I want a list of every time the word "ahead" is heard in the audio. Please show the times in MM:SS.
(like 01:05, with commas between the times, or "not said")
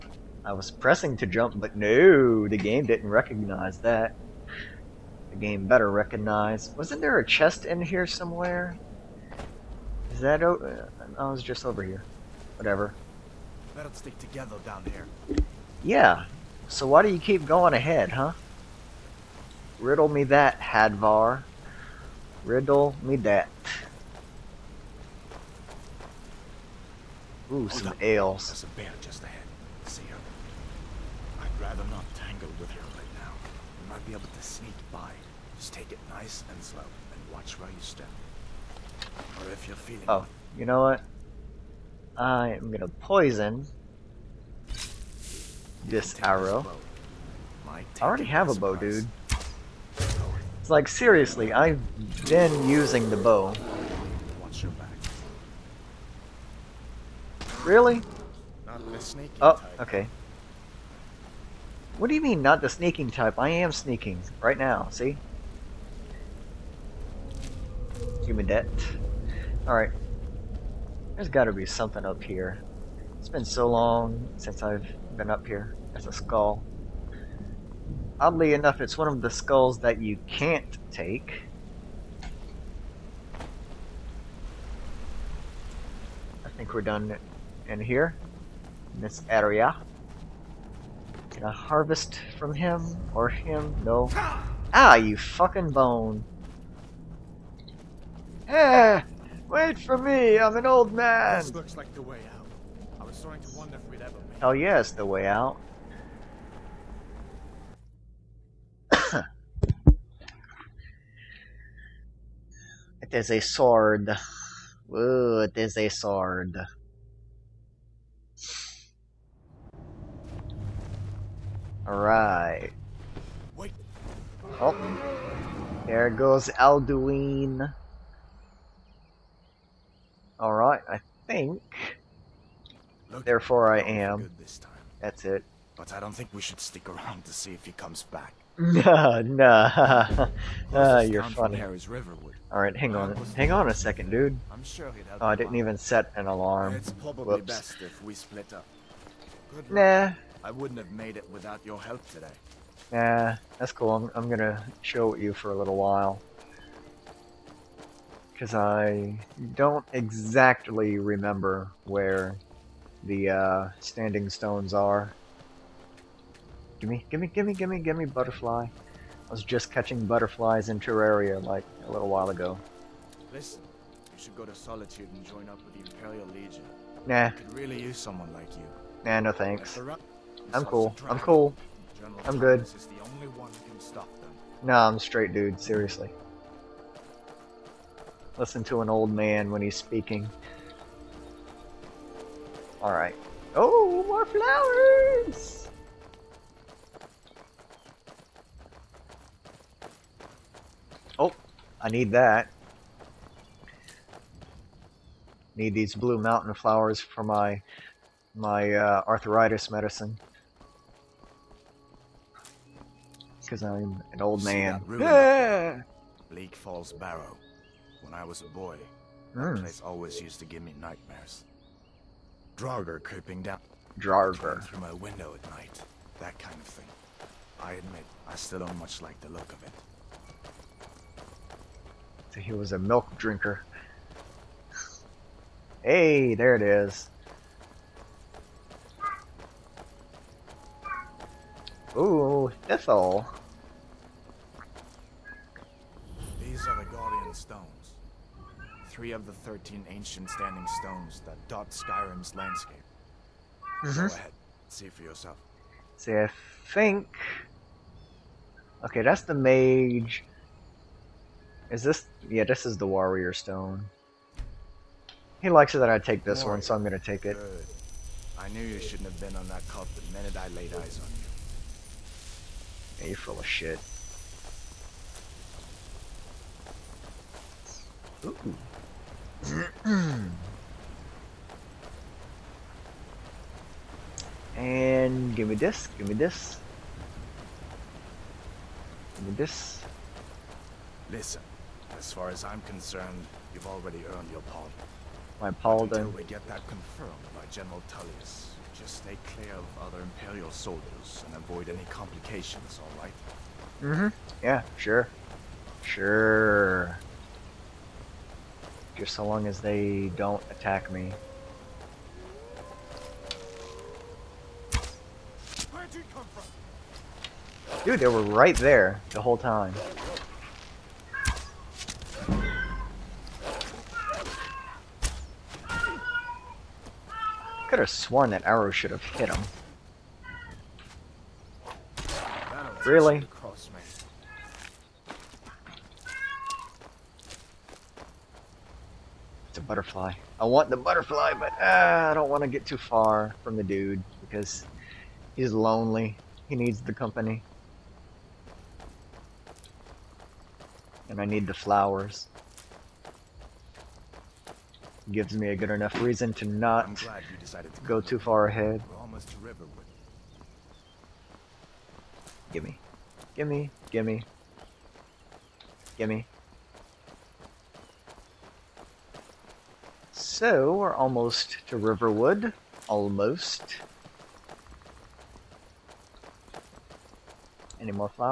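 00:17, 00:29, 04:14, 05:58.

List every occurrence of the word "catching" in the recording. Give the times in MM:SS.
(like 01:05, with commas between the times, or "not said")
02:49.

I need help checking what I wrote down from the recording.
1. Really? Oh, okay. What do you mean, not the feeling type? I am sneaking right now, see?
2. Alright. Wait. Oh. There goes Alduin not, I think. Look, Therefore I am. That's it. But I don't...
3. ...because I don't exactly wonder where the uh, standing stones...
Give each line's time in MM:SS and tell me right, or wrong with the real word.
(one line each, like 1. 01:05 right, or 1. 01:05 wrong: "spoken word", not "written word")
1. 00:57 wrong: "sneaking", not "feeling"
2. 02:01 right
3. 02:38 wrong: "remember", not "wonder".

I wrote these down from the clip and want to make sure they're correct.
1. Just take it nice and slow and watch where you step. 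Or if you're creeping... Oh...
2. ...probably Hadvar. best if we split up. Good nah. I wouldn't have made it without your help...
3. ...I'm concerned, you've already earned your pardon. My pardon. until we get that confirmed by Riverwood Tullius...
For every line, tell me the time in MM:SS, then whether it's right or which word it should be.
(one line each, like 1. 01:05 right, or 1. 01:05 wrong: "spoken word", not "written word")
1. 00:35 wrong: "feeling", not "creeping"
2. 02:26 wrong: "Whoops", not "Hadvar"
3. 04:52 wrong: "General", not "Riverwood".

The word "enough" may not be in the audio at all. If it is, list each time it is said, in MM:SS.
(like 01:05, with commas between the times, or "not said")
01:18, 05:55.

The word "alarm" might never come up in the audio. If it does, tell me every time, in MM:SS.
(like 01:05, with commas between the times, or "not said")
02:26.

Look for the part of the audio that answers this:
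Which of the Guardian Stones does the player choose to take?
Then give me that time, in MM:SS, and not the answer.
04:22.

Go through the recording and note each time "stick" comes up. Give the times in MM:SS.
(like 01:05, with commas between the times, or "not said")
00:13, 02:16.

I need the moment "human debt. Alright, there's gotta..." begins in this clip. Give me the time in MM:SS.
01:08.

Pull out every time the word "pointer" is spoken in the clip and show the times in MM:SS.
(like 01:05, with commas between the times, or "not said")
not said.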